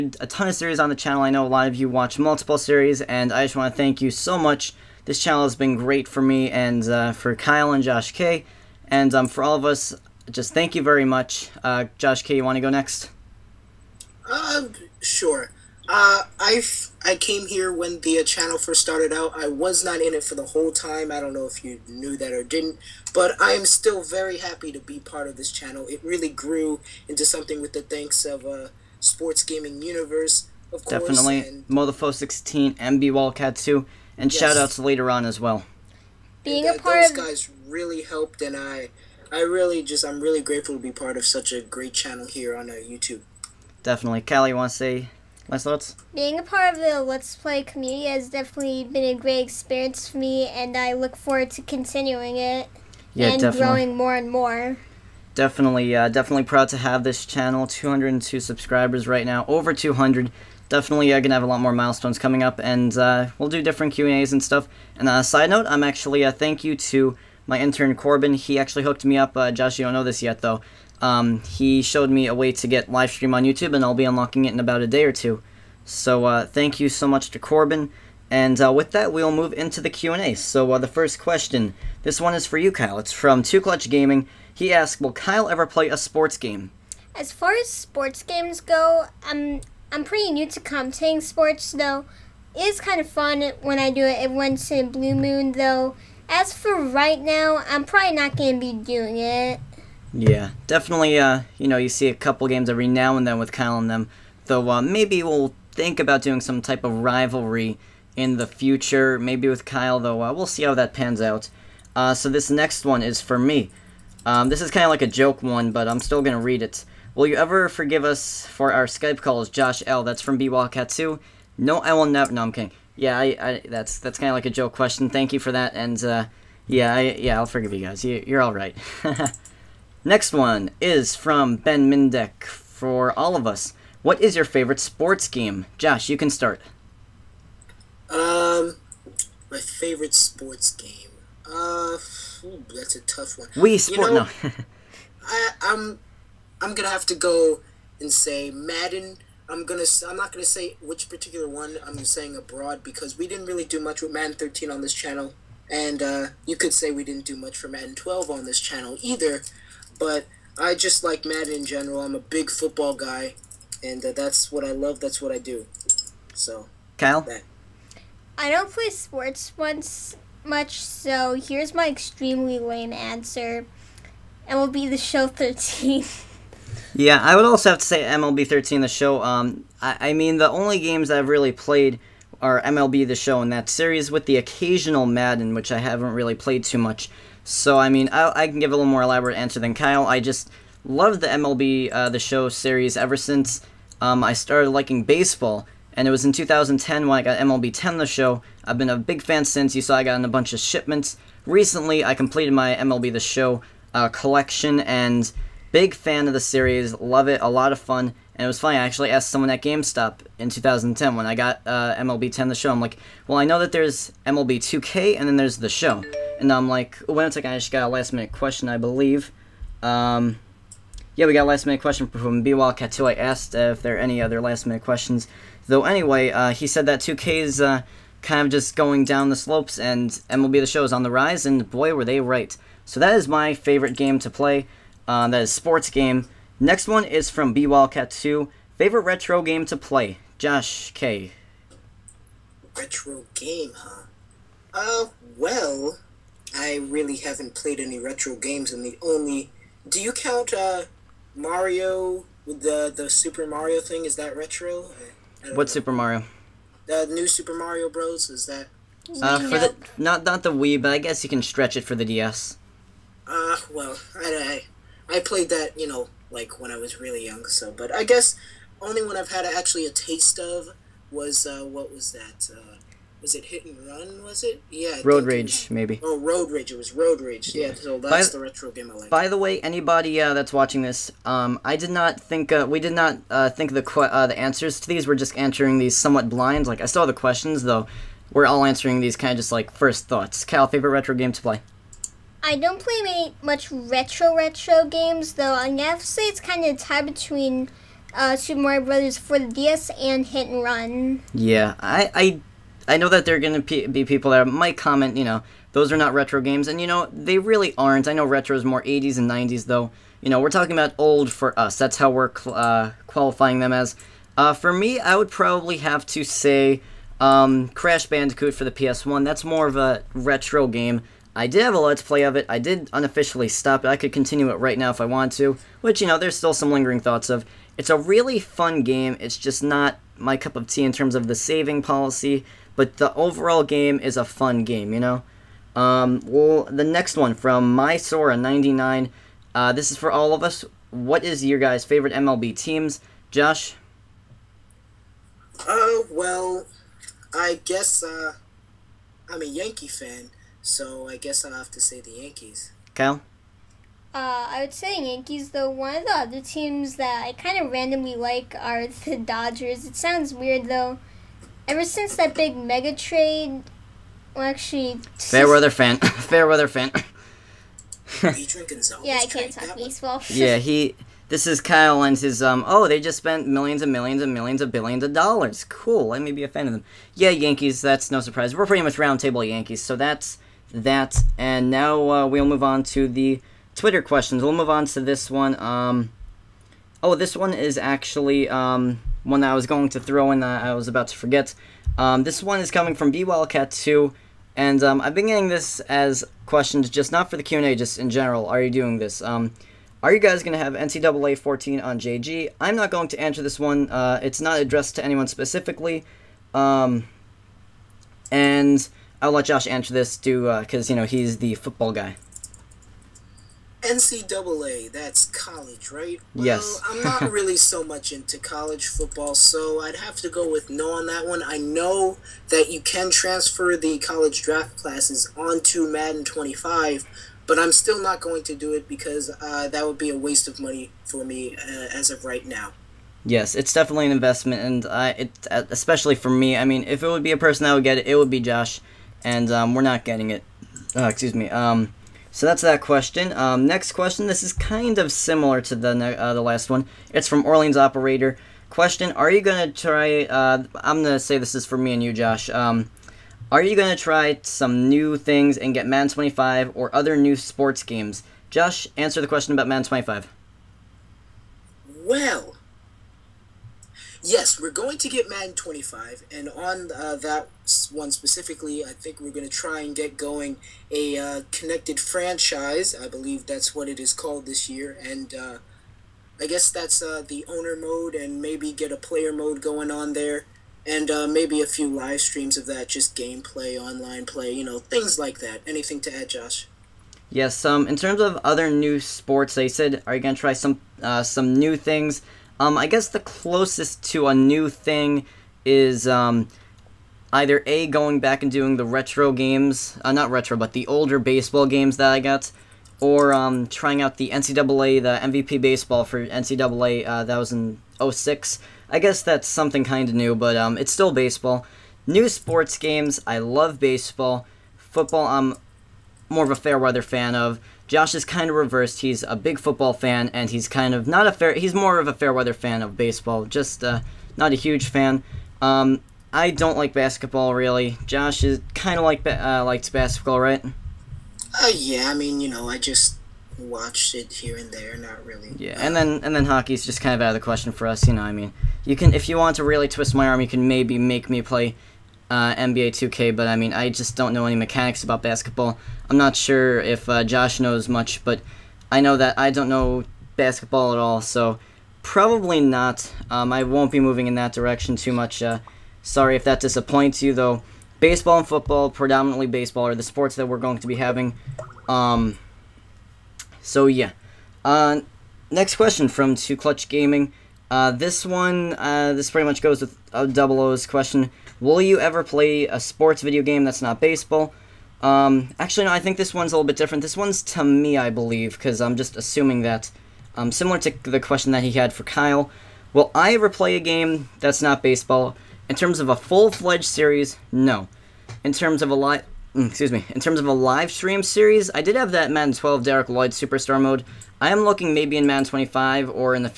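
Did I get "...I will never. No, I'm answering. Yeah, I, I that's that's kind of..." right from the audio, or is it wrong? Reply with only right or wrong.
wrong.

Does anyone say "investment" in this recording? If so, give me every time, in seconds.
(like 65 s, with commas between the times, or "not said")
434 s.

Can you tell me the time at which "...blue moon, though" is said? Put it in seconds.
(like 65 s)
94 s.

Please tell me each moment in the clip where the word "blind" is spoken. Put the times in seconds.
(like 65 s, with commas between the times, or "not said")
286 s.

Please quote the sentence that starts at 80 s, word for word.
So uh, the first question, this one is for you, Kyle.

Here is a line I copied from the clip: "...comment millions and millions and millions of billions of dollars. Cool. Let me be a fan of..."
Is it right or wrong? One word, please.
wrong.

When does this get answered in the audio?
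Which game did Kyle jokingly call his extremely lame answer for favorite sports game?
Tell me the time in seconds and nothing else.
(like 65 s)
174 s.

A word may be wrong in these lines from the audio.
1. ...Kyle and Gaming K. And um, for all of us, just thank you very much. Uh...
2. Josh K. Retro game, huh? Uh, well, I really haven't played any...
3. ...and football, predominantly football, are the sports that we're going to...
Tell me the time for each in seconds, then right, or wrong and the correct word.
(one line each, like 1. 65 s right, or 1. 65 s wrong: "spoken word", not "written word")
1. 7 s wrong: "Josh", not "Gaming"
2. 240 s right
3. 558 s wrong: "baseball", not "football".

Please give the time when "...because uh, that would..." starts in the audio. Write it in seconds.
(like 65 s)
428 s.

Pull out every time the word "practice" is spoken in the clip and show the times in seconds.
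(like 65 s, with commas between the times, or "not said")
not said.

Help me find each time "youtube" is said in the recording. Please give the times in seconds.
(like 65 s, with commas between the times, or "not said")
42 s, 73 s.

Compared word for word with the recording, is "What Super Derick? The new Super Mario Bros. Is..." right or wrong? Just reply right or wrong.
wrong.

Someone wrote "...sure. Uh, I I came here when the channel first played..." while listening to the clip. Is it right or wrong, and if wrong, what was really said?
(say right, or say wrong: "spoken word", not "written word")
wrong: "started", not "played".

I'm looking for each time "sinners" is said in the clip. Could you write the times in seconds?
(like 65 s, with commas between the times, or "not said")
not said.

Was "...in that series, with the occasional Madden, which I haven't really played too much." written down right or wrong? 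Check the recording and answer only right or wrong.
right.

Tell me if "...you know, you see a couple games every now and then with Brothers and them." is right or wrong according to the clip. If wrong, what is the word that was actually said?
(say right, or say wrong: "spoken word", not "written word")
wrong: "Kyle", not "Brothers".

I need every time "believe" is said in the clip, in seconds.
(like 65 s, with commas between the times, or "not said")
218 s, 473 s, 578 s.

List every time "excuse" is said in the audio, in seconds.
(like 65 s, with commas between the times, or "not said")
441 s, 589 s.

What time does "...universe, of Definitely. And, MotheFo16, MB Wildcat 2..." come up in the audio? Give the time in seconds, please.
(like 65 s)
29 s.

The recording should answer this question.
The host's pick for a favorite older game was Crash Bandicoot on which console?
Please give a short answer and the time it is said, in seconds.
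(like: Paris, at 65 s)
PS1, at 318 s.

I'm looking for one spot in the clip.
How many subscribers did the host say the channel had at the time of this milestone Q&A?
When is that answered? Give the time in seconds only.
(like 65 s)
57 s.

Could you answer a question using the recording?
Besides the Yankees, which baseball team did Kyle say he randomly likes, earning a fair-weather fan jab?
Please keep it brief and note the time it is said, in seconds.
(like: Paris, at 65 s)
Dodgers, at 359 s.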